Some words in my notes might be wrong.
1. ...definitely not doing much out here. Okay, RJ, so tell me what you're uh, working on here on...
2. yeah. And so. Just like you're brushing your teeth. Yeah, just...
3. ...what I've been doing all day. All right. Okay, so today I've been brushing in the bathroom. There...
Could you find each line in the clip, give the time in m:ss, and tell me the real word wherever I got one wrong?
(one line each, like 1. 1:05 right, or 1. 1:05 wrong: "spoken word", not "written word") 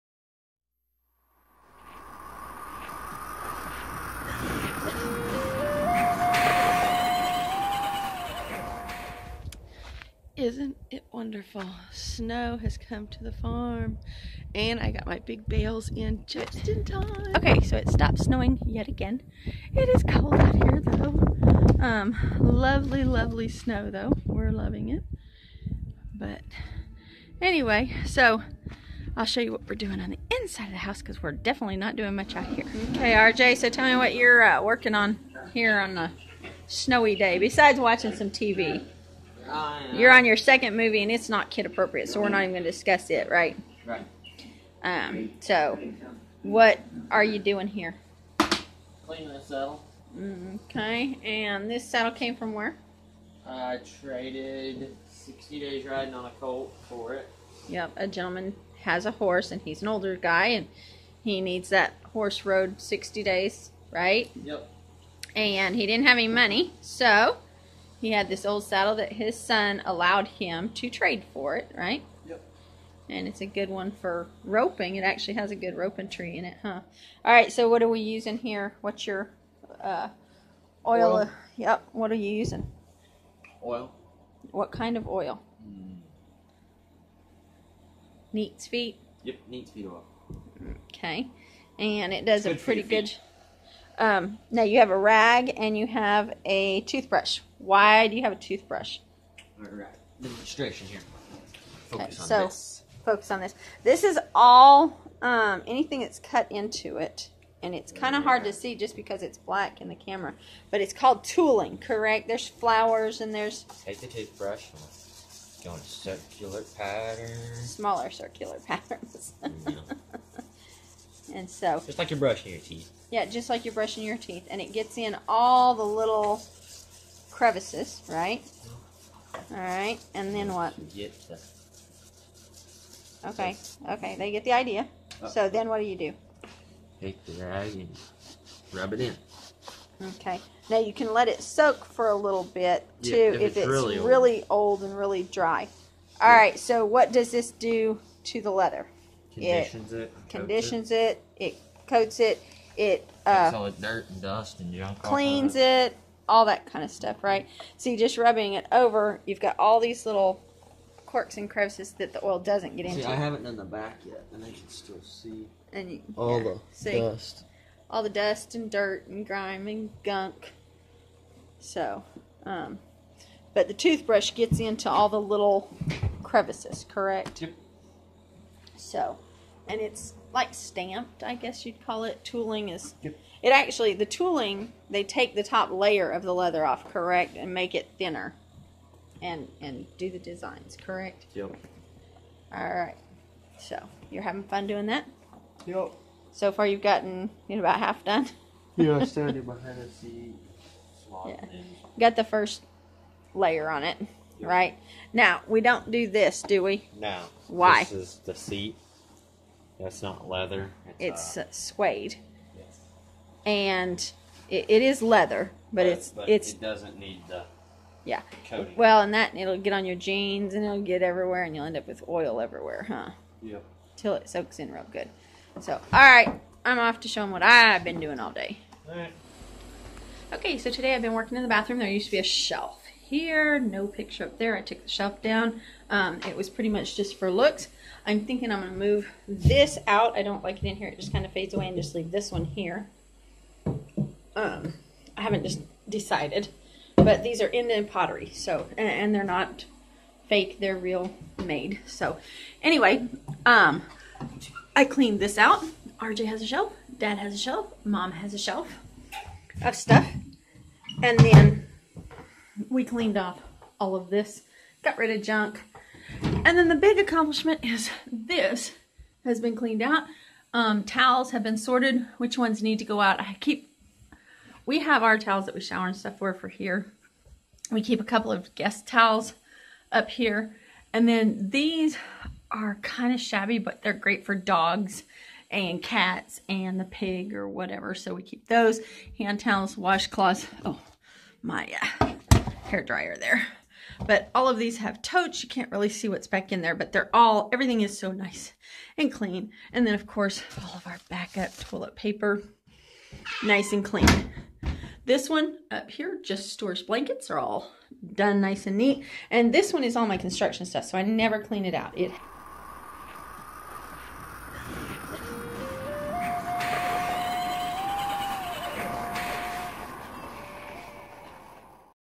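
1. 0:31 right
2. 1:59 right
3. 3:47 wrong: "working", not "brushing".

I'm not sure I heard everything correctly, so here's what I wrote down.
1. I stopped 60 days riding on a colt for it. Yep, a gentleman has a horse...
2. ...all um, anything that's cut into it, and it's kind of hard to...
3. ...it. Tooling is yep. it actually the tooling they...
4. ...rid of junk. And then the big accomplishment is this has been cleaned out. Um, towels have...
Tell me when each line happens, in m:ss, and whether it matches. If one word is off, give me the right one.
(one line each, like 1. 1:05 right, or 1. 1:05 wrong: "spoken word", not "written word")
1. 0:53 wrong: "traded", not "stopped"
2. 1:44 right
3. 3:02 right
4. 4:24 right.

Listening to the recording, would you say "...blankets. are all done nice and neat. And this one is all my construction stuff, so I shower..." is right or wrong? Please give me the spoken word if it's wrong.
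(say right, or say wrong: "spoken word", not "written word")
wrong: "never", not "shower".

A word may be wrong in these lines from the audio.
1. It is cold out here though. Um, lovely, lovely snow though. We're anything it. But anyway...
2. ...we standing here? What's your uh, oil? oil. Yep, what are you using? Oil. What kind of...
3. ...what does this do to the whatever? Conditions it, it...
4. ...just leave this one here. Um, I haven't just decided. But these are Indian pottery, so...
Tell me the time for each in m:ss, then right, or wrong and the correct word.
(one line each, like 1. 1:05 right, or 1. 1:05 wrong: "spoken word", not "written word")
1. 0:19 wrong: "loving", not "anything"
2. 1:17 wrong: "using", not "standing"
3. 2:26 wrong: "leather", not "whatever"
4. 4:01 right.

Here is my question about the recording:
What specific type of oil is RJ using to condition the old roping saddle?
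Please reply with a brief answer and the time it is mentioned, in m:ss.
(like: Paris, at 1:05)
Neat's feet oil, at 1:29.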